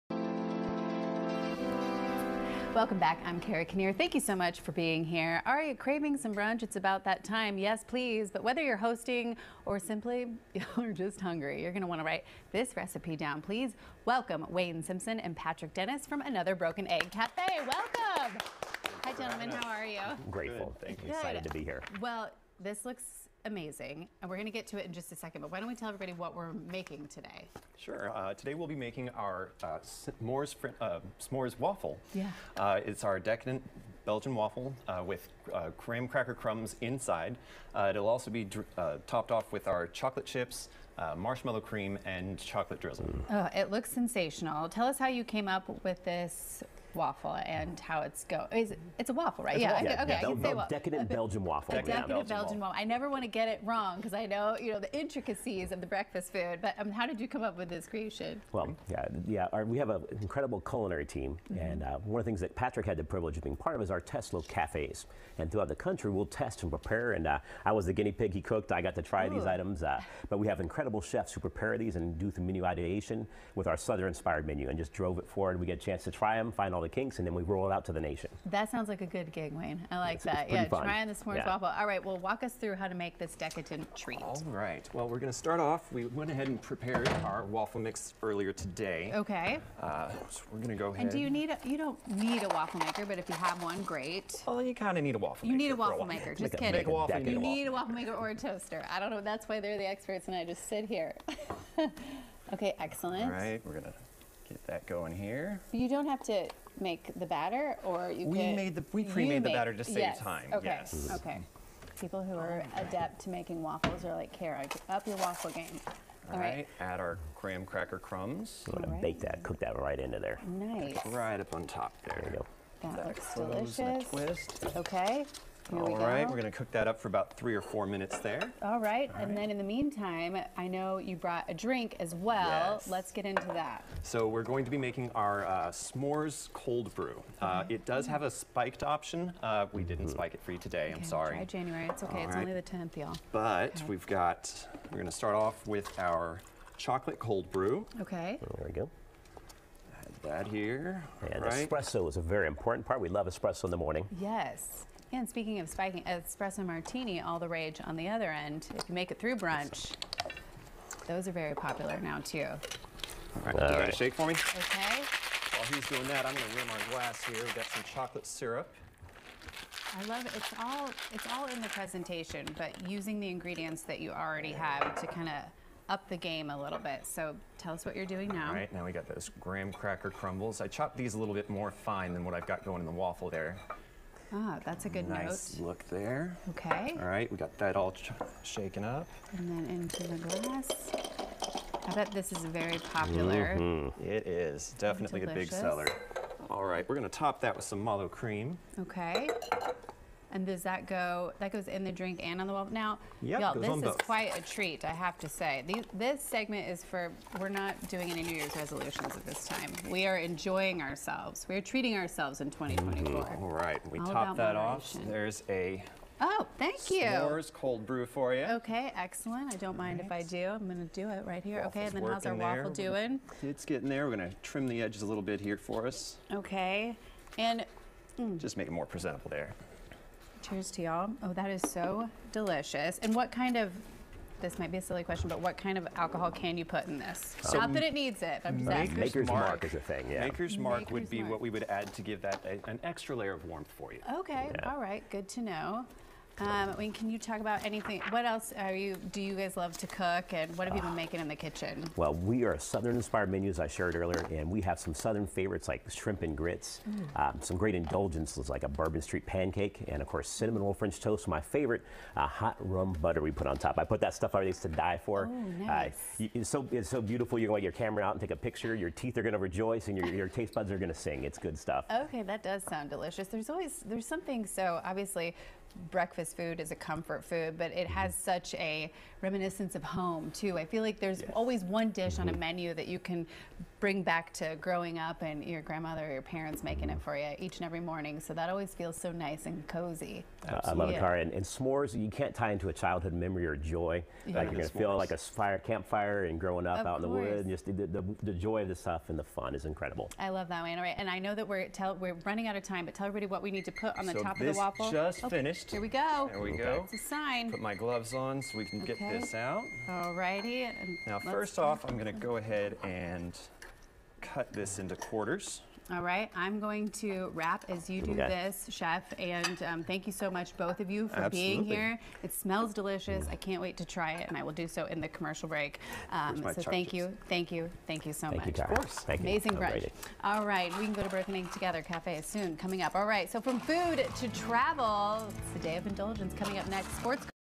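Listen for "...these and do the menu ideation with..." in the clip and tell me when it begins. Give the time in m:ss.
1:11.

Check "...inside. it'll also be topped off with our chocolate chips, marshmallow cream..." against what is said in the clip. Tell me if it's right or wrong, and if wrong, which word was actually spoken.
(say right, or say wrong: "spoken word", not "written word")
right.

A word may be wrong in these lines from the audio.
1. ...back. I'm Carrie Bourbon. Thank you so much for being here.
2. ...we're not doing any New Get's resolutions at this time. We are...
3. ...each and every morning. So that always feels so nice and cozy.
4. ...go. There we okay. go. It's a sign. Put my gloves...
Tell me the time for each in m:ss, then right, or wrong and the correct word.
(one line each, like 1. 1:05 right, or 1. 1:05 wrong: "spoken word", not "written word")
1. 0:02 wrong: "Kinnear", not "Bourbon"
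2. 3:27 wrong: "Year", not "Get"
3. 4:47 right
4. 5:05 right.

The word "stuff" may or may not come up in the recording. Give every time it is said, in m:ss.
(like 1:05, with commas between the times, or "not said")
4:24, 4:31, 4:58.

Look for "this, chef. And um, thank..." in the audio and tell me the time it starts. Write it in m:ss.
5:18.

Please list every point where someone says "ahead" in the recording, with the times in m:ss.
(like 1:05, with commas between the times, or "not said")
1:26, 1:30, 5:12.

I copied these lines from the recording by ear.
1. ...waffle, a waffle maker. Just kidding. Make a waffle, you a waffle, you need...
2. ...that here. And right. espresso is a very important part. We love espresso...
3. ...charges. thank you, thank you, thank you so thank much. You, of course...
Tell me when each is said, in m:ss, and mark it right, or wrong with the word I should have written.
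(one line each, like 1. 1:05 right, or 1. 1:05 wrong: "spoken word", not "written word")
1. 1:35 right
2. 2:30 right
3. 5:26 right.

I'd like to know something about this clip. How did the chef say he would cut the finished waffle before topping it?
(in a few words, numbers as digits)
quarters.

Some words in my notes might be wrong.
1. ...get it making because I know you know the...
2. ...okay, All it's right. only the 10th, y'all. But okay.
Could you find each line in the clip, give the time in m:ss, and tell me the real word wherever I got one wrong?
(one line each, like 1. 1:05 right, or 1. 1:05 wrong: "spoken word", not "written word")
1. 0:53 wrong: "wrong", not "making"
2. 2:22 right.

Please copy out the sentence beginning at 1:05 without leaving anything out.
And throughout the country, we'll test and prepare.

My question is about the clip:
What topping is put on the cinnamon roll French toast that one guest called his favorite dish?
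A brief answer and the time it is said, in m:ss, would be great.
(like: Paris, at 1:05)
hot rum butter, at 4:22.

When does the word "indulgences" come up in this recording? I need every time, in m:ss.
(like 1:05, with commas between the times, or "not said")
4:17, 5:35.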